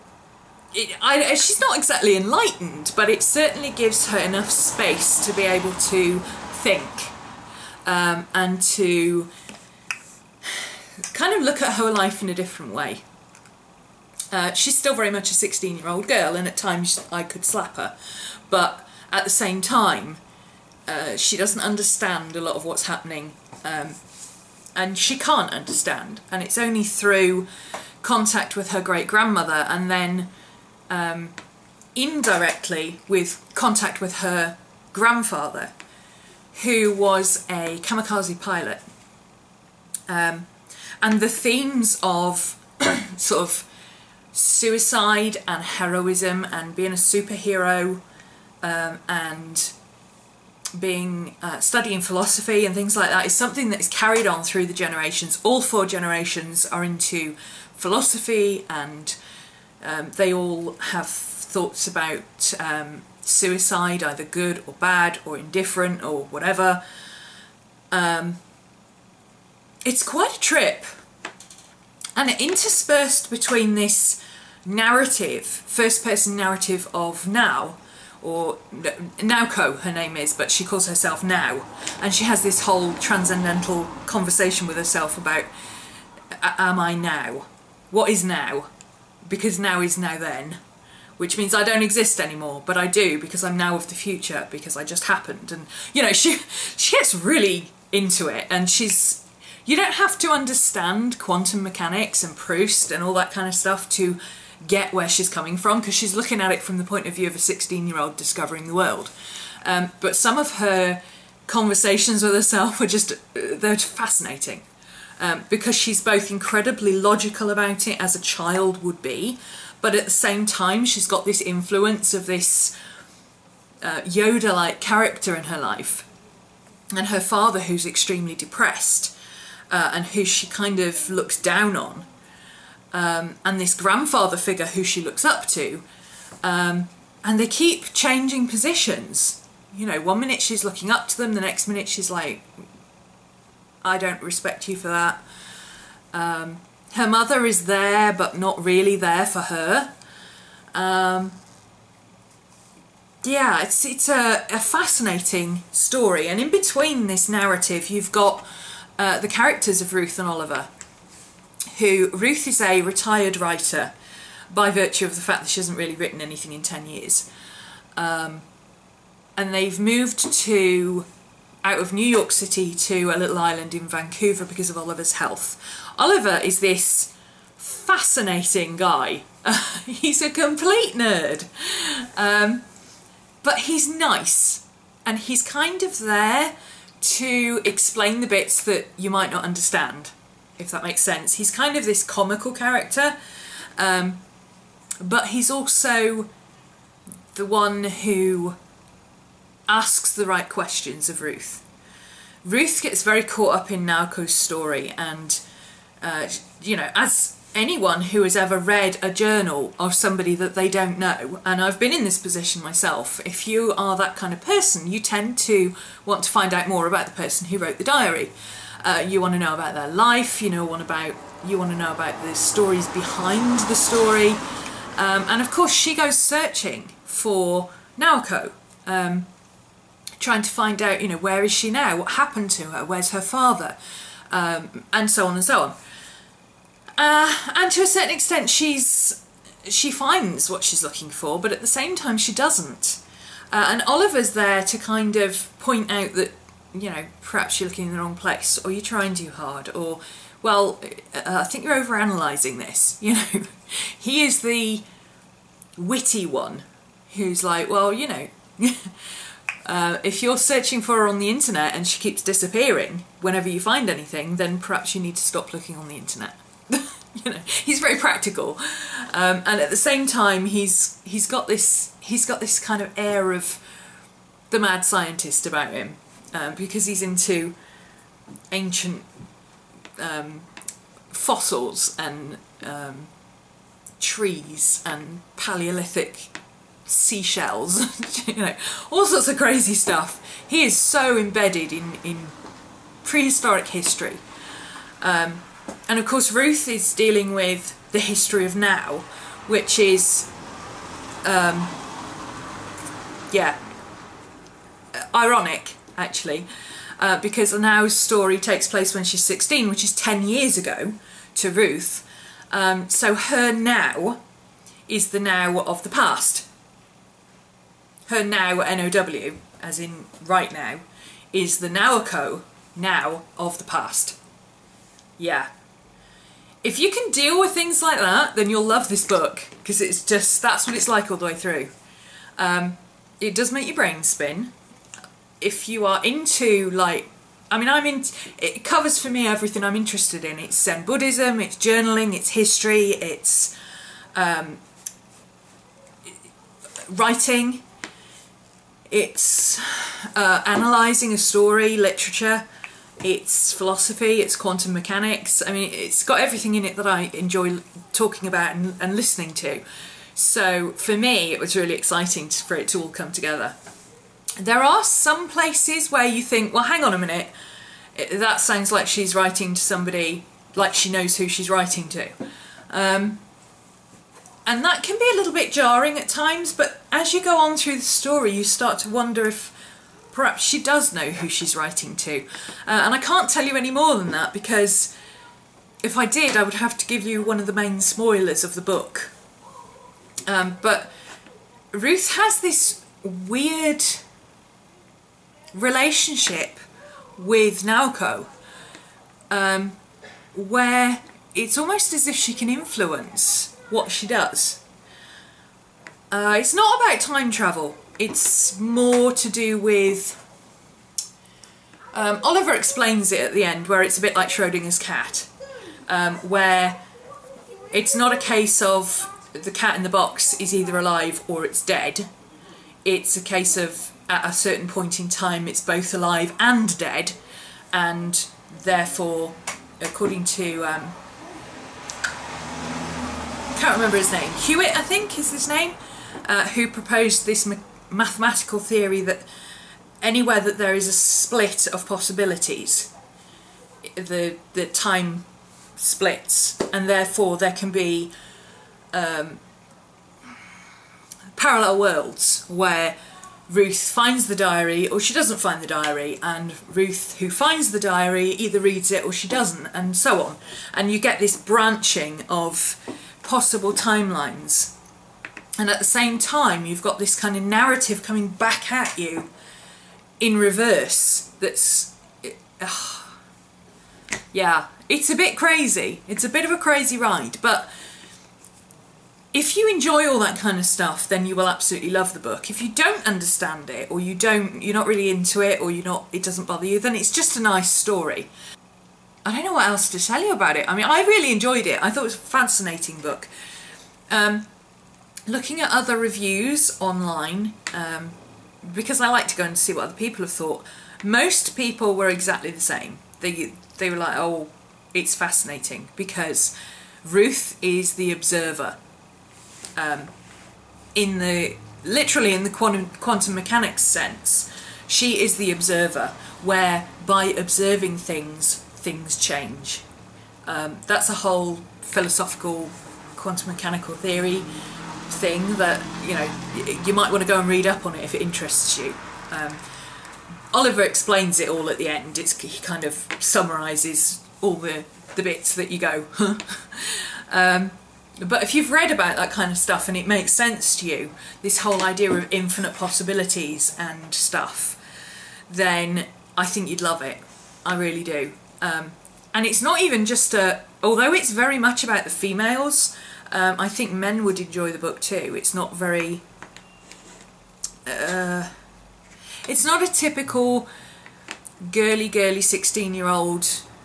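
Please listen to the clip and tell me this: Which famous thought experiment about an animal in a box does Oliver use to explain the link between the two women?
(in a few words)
Schrodinger's cat.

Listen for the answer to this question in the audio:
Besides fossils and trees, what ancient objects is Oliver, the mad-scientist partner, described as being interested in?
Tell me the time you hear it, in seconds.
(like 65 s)
285 s.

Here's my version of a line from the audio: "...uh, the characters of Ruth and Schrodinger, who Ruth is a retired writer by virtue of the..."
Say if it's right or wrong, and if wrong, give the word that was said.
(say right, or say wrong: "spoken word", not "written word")
wrong: "Oliver", not "Schrodinger".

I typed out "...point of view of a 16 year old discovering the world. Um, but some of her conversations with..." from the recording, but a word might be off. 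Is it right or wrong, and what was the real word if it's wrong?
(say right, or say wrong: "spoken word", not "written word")
right.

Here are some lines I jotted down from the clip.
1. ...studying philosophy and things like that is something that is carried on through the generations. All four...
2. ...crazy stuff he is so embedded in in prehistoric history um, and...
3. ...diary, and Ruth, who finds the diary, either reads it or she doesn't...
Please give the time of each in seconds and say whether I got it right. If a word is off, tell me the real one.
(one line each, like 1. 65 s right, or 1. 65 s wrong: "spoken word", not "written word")
1. 51 s right
2. 289 s right
3. 455 s right.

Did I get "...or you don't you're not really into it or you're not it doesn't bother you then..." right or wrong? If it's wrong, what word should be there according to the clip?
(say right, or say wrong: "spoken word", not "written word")
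right.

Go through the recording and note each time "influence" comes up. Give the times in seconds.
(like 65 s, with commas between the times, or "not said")
121 s, 402 s.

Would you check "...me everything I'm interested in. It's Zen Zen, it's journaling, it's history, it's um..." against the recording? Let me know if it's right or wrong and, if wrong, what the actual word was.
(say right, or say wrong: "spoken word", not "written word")
wrong: "Buddhism", not "Zen".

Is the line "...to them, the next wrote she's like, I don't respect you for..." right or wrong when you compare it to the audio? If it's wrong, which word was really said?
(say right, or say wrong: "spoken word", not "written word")
wrong: "minute", not "wrote".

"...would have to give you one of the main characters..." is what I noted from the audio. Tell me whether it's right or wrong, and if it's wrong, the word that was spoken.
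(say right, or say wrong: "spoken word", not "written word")
wrong: "spoilers", not "characters".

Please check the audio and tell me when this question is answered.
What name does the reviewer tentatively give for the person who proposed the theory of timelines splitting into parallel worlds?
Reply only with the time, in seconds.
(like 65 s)
434 s.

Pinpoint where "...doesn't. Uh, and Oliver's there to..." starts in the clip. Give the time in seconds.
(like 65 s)
242 s.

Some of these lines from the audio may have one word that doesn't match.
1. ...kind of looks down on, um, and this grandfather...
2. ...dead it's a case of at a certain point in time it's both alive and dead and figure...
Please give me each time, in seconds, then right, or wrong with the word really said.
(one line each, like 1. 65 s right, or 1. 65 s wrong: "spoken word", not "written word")
1. 130 s right
2. 421 s wrong: "therefore", not "figure".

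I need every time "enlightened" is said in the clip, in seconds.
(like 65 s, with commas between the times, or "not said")
2 s.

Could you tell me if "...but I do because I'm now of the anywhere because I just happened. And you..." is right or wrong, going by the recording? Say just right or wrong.
wrong.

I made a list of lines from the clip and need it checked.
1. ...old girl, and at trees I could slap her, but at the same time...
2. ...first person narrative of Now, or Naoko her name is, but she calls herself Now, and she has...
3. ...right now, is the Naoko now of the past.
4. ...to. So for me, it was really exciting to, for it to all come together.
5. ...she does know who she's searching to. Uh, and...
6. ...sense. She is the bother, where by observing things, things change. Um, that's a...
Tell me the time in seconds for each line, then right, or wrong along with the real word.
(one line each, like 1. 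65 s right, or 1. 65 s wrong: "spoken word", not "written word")
1. 15 s wrong: "times", not "trees"
2. 75 s right
3. 320 s right
4. 359 s right
5. 380 s wrong: "writing", not "searching"
6. 513 s wrong: "observer", not "bother".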